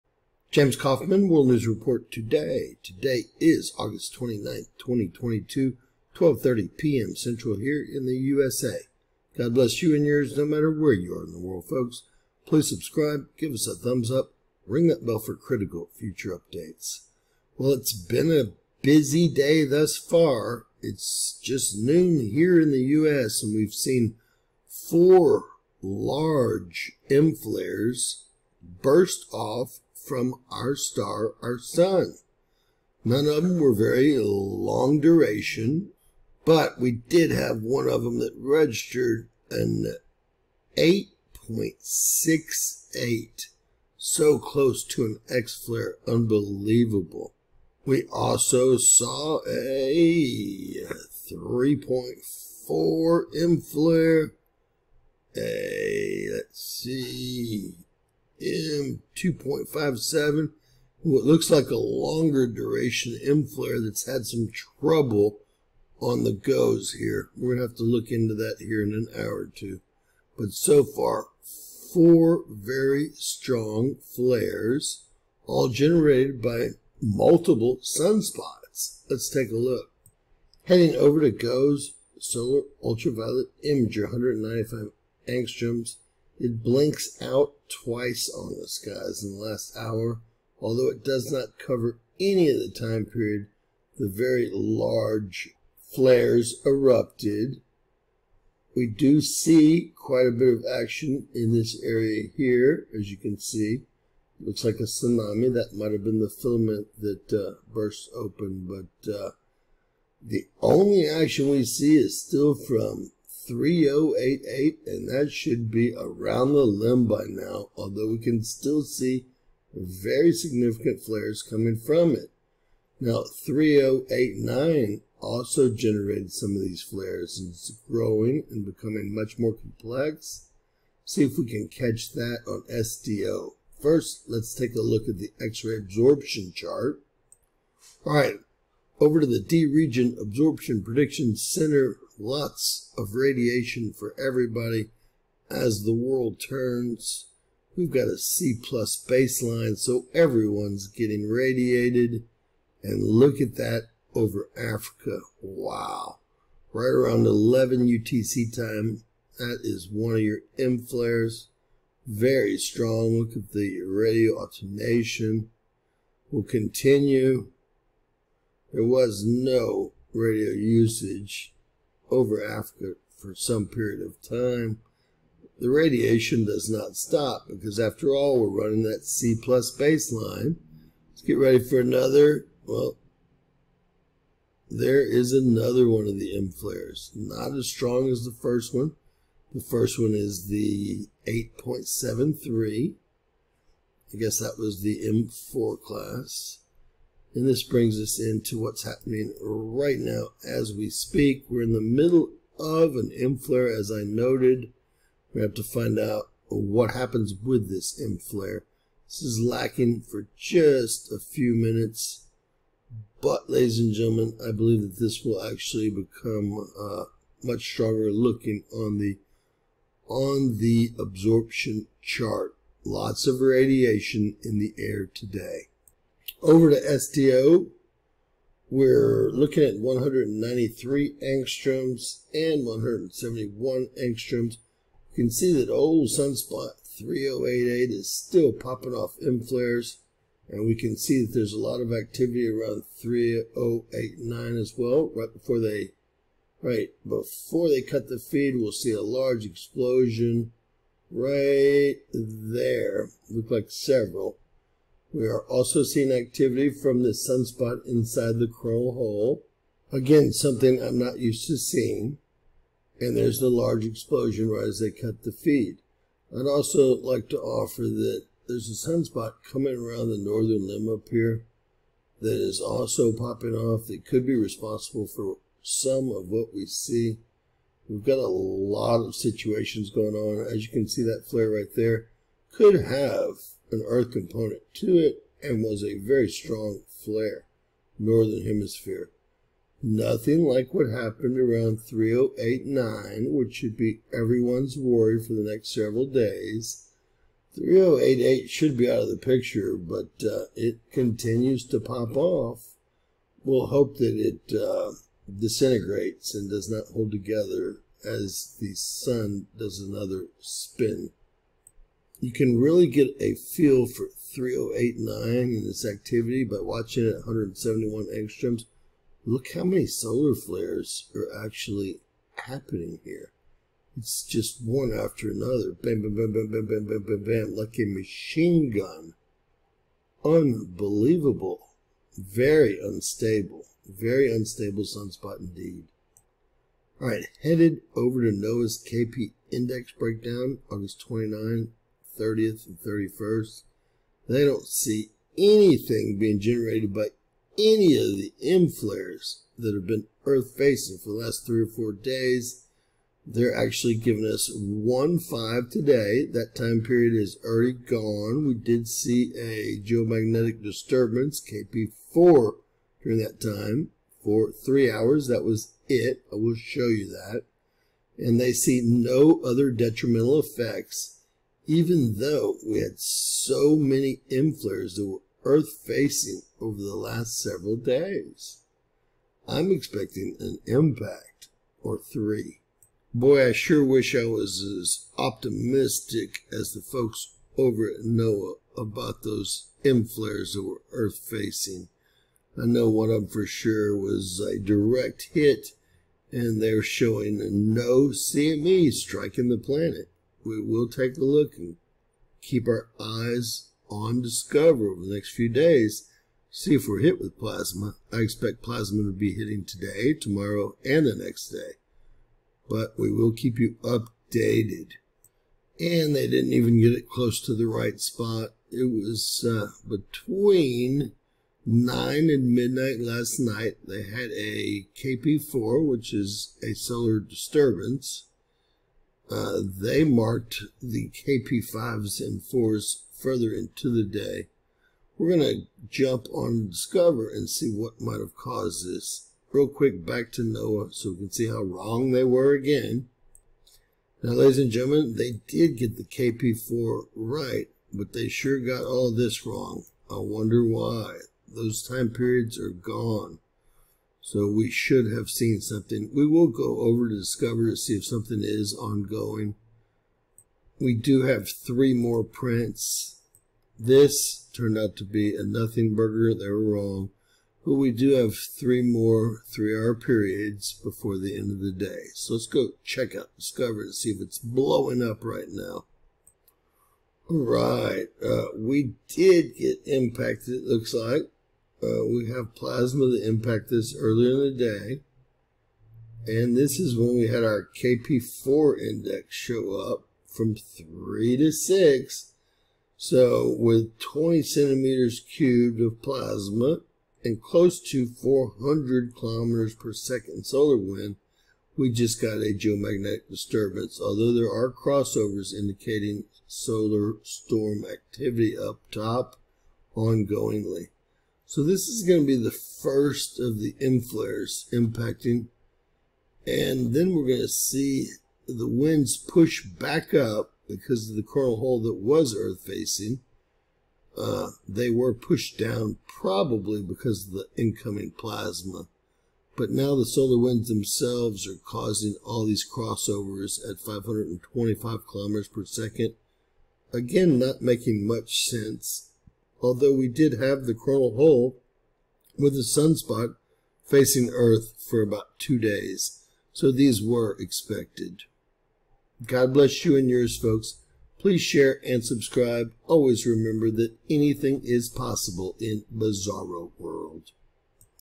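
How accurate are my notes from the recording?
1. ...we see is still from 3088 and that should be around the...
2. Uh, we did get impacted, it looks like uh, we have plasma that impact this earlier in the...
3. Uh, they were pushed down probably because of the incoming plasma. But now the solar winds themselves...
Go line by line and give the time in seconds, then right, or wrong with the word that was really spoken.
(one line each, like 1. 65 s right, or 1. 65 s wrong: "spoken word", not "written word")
1. 111 s right
2. 478 s right
3. 524 s right.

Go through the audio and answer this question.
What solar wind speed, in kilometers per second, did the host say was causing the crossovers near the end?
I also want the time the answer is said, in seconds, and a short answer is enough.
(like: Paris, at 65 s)
525, at 533 s.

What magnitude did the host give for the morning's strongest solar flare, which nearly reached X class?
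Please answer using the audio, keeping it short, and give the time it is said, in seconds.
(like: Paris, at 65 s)
8.68, at 40 s.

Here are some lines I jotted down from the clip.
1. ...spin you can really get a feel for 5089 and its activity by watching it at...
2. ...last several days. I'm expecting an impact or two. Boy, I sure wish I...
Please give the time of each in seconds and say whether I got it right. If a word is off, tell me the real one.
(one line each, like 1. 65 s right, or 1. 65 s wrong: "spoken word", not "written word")
1. 310 s wrong: "3089", not "5089"
2. 376 s wrong: "three", not "two".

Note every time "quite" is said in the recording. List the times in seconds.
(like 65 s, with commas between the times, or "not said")
99 s.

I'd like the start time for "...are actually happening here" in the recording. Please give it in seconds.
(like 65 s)
321 s.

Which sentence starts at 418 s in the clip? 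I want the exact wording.
It was uh, between 9 and midnight last night.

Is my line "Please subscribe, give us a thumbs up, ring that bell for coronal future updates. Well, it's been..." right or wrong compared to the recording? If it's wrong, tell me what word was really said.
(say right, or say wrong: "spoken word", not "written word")
wrong: "critical", not "coronal".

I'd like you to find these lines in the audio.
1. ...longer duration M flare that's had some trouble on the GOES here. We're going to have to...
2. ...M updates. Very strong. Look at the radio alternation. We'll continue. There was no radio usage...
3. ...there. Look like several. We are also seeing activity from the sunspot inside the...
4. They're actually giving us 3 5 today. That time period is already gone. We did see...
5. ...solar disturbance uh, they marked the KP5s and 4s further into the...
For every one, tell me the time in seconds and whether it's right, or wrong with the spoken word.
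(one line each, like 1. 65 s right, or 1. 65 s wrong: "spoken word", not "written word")
1. 61 s right
2. 160 s wrong: "flares", not "updates"
3. 252 s right
4. 353 s wrong: "1", not "3"
5. 426 s right.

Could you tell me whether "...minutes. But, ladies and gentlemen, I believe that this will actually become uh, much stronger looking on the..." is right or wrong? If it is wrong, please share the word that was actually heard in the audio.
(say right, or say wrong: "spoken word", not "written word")
right.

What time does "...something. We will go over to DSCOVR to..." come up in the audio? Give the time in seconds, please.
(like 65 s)
455 s.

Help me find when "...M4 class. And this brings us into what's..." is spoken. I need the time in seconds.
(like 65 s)
195 s.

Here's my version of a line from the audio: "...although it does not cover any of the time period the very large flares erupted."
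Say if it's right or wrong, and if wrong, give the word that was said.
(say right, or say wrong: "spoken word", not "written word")
right.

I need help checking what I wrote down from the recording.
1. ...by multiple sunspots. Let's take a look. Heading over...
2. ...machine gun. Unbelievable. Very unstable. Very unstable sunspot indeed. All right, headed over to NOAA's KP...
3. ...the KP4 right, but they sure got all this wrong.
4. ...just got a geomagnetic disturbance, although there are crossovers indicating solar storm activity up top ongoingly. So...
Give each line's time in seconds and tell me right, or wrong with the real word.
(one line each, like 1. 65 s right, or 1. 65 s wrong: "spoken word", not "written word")
1. 76 s right
2. 327 s right
3. 445 s right
4. 501 s right.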